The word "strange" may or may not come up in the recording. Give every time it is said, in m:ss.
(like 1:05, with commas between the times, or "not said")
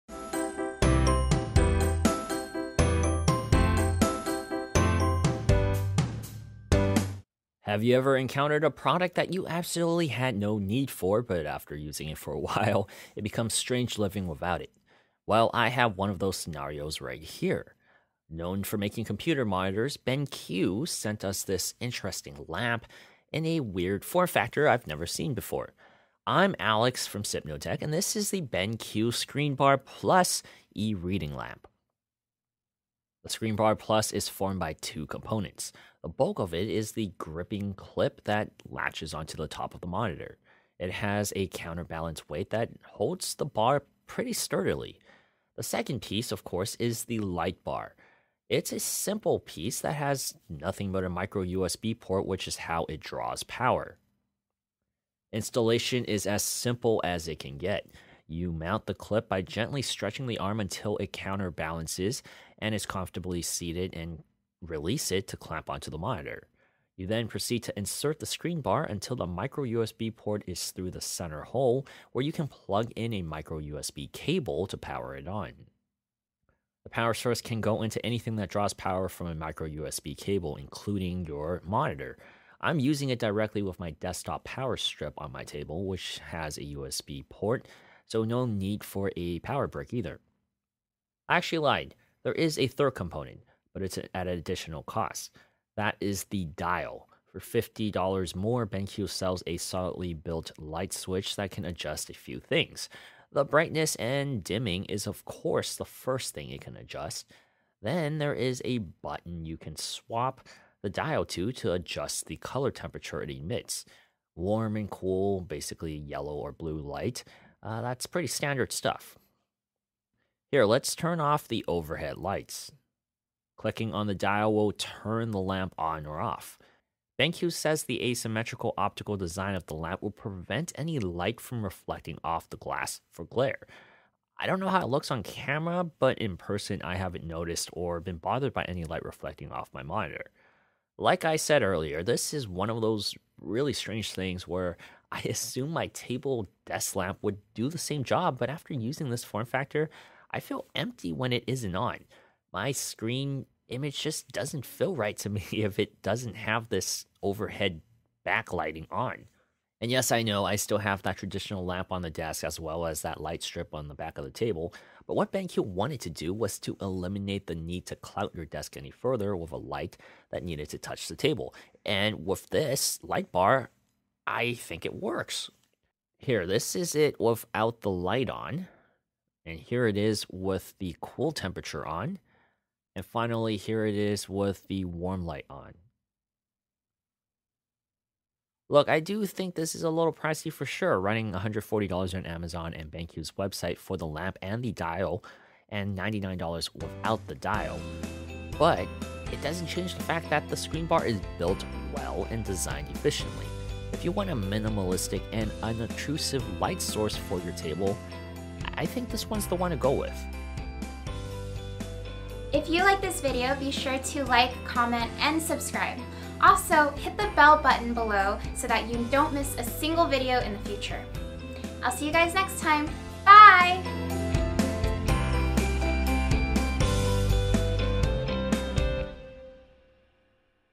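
0:13, 2:23.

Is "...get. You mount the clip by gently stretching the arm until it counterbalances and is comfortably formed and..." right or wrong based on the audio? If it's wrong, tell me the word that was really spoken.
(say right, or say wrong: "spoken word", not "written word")
wrong: "seated", not "formed".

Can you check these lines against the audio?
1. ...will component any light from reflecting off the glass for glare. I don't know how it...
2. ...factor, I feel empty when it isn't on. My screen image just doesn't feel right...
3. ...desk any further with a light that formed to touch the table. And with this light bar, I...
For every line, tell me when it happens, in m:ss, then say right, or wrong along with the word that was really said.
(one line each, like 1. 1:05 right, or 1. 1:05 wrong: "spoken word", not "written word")
1. 2:10 wrong: "prevent", not "component"
2. 2:29 right
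3. 2:48 wrong: "needed", not "formed".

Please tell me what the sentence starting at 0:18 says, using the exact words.
Known for making computer monitors, BenQ sent us this interesting lamp in a weird form factor I've never seen before.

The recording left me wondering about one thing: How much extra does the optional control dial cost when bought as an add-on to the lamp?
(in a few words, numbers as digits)
$50.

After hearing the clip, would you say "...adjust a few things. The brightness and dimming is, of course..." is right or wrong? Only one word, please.
right.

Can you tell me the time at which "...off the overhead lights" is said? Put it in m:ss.
2:01.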